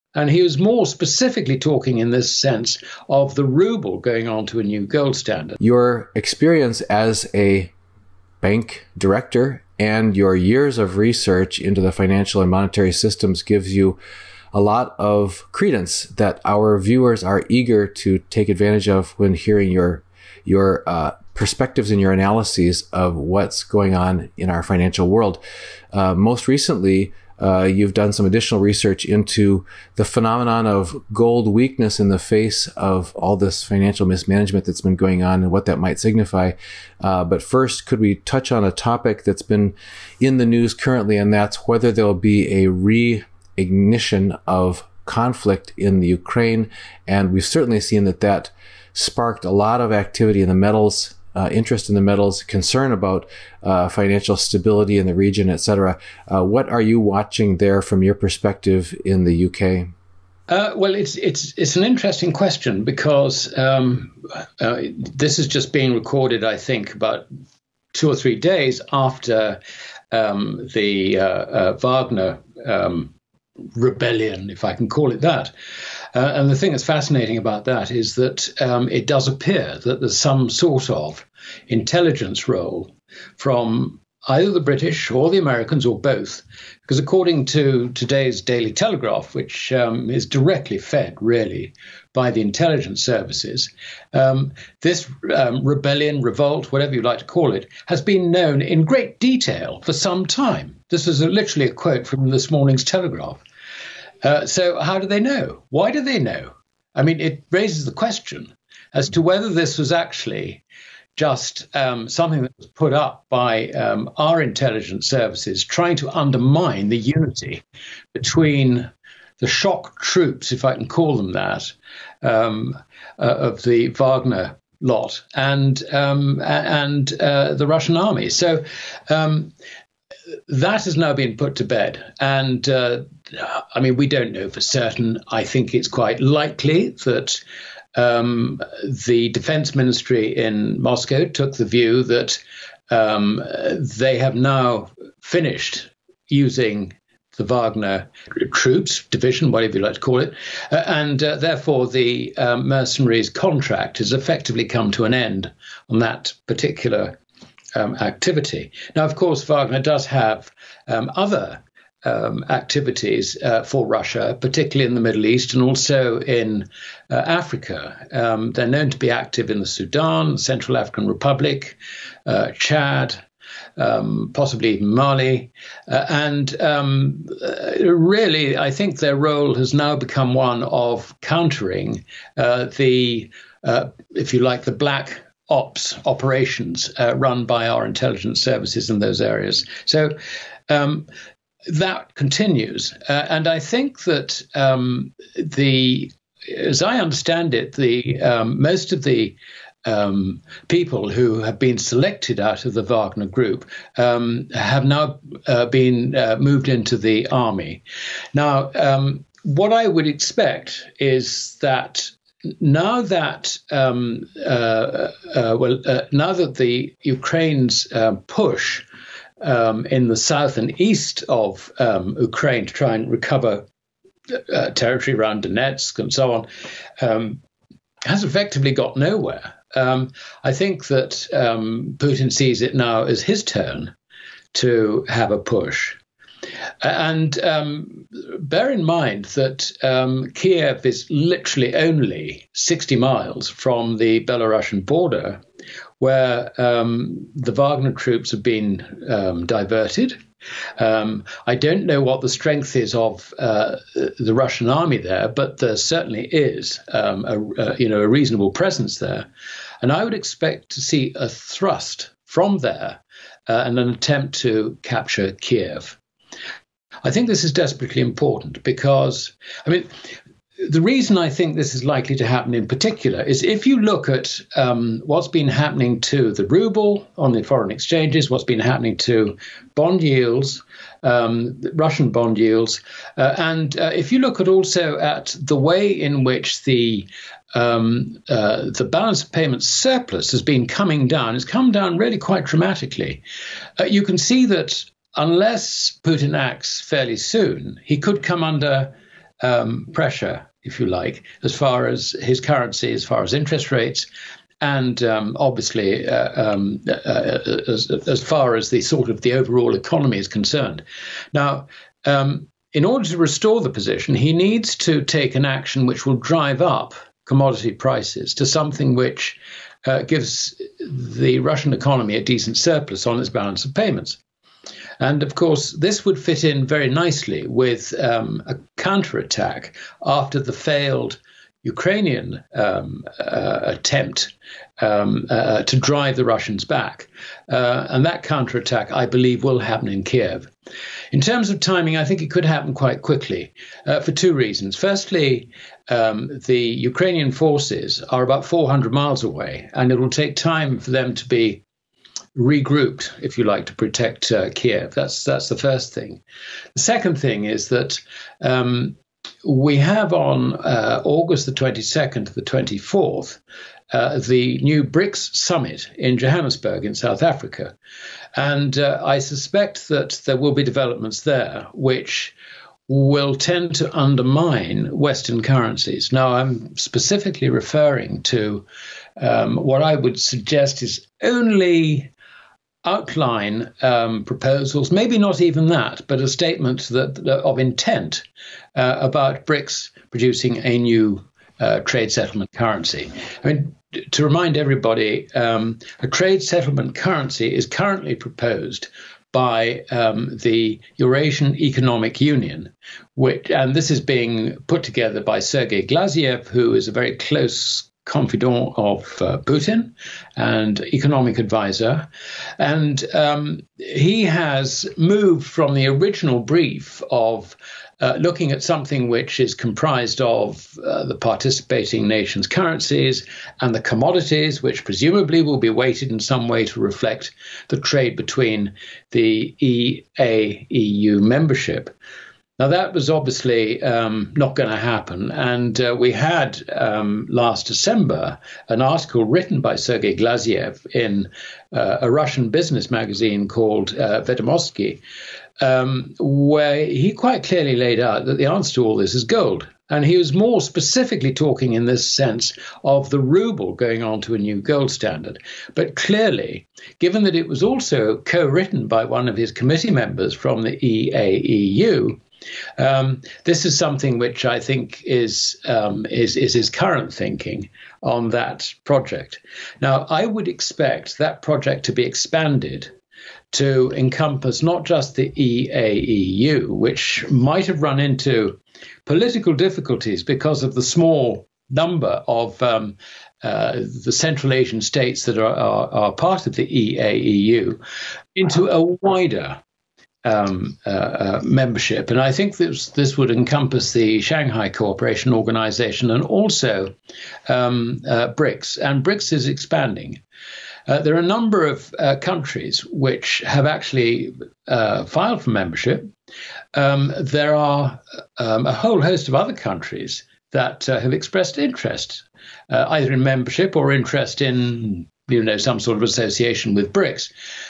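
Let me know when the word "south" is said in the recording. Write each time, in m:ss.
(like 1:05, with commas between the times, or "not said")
3:40, 6:06.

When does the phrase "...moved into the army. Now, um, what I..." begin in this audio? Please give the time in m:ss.
3:26.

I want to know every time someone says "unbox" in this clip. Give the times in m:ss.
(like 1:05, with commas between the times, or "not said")
not said.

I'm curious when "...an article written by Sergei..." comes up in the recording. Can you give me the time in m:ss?
7:18.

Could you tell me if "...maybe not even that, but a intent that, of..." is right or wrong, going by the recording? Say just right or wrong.
wrong.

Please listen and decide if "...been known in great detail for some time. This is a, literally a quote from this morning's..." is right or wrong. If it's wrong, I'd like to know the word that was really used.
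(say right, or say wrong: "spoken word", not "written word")
right.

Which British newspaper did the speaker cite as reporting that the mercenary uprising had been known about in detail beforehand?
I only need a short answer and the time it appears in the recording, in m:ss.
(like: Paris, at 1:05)
Daily Telegraph, at 1:28.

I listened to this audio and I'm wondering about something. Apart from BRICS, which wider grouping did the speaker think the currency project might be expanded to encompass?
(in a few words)
Shanghai Cooperation Organization.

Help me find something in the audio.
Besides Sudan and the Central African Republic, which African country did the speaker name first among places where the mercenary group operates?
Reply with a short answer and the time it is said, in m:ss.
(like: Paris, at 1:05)
Chad, at 2:52.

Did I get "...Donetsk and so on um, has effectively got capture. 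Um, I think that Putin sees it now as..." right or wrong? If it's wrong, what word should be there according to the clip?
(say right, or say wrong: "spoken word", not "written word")
wrong: "nowhere", not "capture".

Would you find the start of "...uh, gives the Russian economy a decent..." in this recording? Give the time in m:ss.
5:19.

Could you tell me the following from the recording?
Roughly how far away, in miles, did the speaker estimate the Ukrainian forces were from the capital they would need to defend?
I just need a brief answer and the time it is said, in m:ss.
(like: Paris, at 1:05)
400, at 5:48.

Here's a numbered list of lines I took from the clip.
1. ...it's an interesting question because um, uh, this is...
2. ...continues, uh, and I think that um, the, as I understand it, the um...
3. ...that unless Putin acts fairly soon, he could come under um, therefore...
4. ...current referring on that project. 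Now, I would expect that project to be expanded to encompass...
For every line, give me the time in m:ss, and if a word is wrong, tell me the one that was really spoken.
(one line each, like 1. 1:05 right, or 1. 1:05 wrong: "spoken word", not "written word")
1. 1:01 right
2. 3:12 right
3. 4:54 wrong: "pressure", not "therefore"
4. 7:46 wrong: "thinking", not "referring".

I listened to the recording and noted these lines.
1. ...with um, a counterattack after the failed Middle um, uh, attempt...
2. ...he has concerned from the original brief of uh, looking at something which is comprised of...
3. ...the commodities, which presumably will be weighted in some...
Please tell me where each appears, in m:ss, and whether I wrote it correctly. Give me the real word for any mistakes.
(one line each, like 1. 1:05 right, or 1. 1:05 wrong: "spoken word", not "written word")
1. 5:27 wrong: "Ukrainian", not "Middle"
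2. 6:53 wrong: "moved", not "concerned"
3. 7:03 right.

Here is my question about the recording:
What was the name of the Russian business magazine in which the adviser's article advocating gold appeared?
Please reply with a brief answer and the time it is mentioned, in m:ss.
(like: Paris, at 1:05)
Vedomosti, at 7:24.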